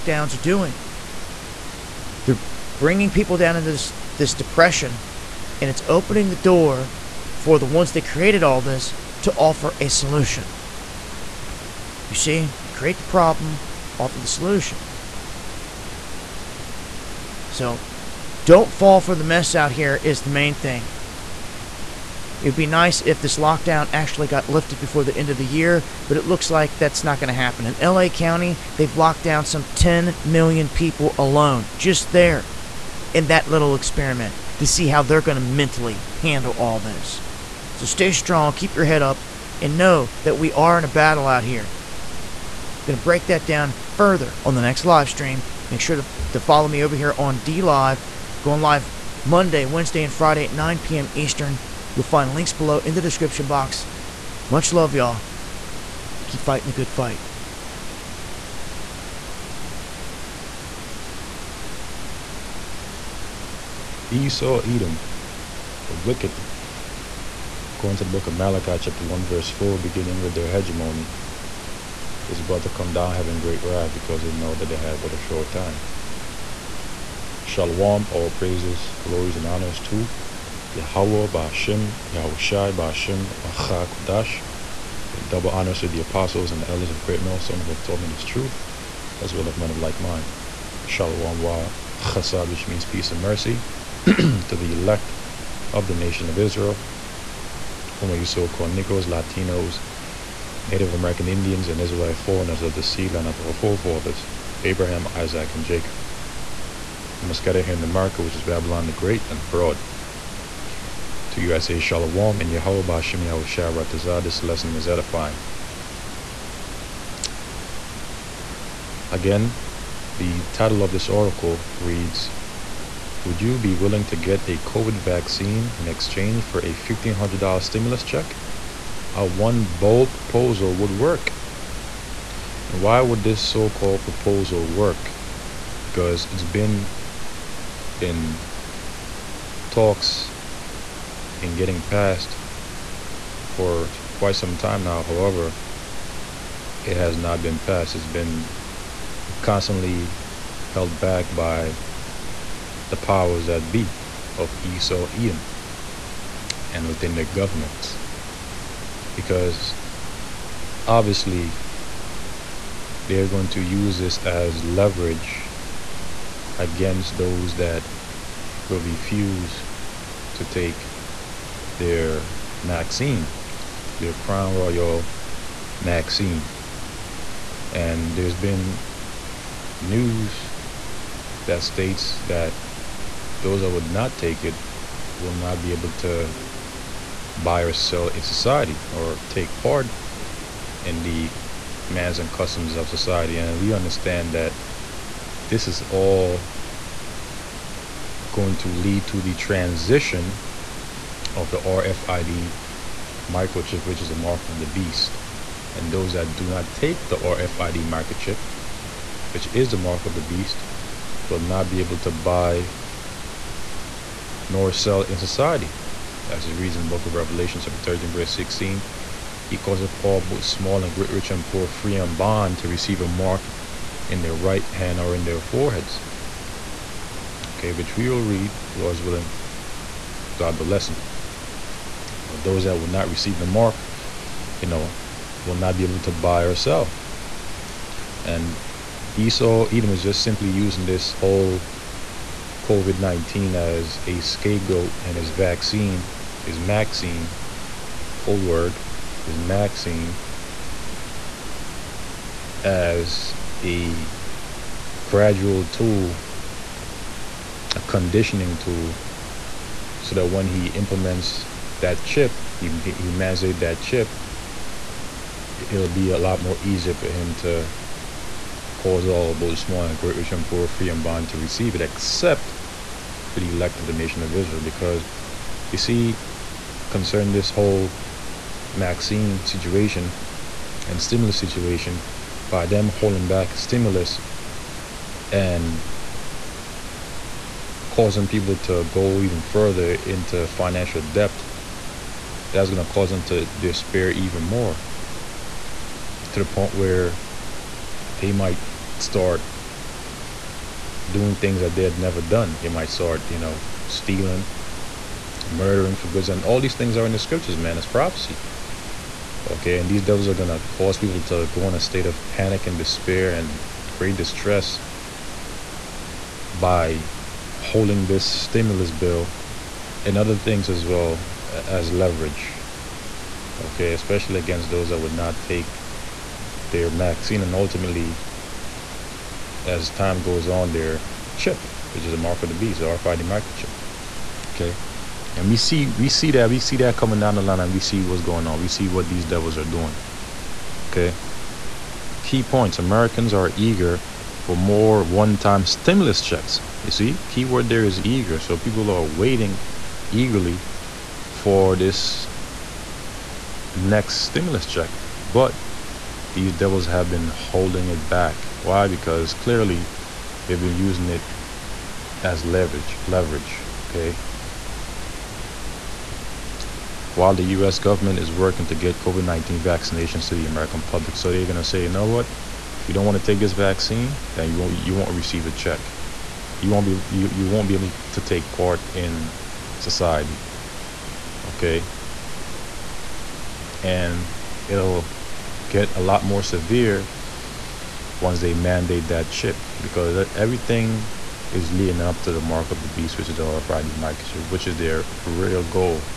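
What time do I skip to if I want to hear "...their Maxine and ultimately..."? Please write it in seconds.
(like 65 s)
326 s.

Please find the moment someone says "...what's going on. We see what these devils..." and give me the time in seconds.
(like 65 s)
338 s.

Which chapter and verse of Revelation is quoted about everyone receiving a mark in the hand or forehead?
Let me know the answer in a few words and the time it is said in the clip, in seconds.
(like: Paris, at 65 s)
Chapter 13, verse 16, at 217 s.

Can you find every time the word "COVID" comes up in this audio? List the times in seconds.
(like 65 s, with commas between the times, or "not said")
124 s, 242 s, 368 s.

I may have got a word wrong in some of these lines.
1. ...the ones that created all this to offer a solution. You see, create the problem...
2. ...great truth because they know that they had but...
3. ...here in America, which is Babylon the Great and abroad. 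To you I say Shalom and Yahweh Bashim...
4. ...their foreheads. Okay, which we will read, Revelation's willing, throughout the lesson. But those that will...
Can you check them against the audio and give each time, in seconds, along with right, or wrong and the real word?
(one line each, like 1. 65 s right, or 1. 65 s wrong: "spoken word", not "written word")
1. 7 s right
2. 73 s wrong: "wrath", not "truth"
3. 107 s right
4. 225 s wrong: "Lord", not "Revelation".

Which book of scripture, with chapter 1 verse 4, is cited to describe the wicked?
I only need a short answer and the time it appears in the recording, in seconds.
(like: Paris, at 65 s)
Malachi, at 68 s.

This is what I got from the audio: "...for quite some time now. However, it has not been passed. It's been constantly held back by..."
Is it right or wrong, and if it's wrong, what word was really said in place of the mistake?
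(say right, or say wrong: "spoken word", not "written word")
right.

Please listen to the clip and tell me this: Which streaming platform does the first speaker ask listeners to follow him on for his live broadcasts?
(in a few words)
DLive.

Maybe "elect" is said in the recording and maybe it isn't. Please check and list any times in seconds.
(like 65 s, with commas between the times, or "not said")
94 s, 273 s.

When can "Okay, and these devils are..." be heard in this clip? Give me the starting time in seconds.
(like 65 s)
309 s.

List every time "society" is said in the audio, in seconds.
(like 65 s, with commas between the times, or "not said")
188 s, 192 s, 215 s, 379 s.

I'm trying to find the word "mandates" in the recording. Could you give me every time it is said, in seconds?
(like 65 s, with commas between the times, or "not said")
263 s, 388 s.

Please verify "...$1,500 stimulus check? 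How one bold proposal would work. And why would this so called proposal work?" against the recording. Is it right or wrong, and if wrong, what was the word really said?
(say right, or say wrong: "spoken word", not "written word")
right.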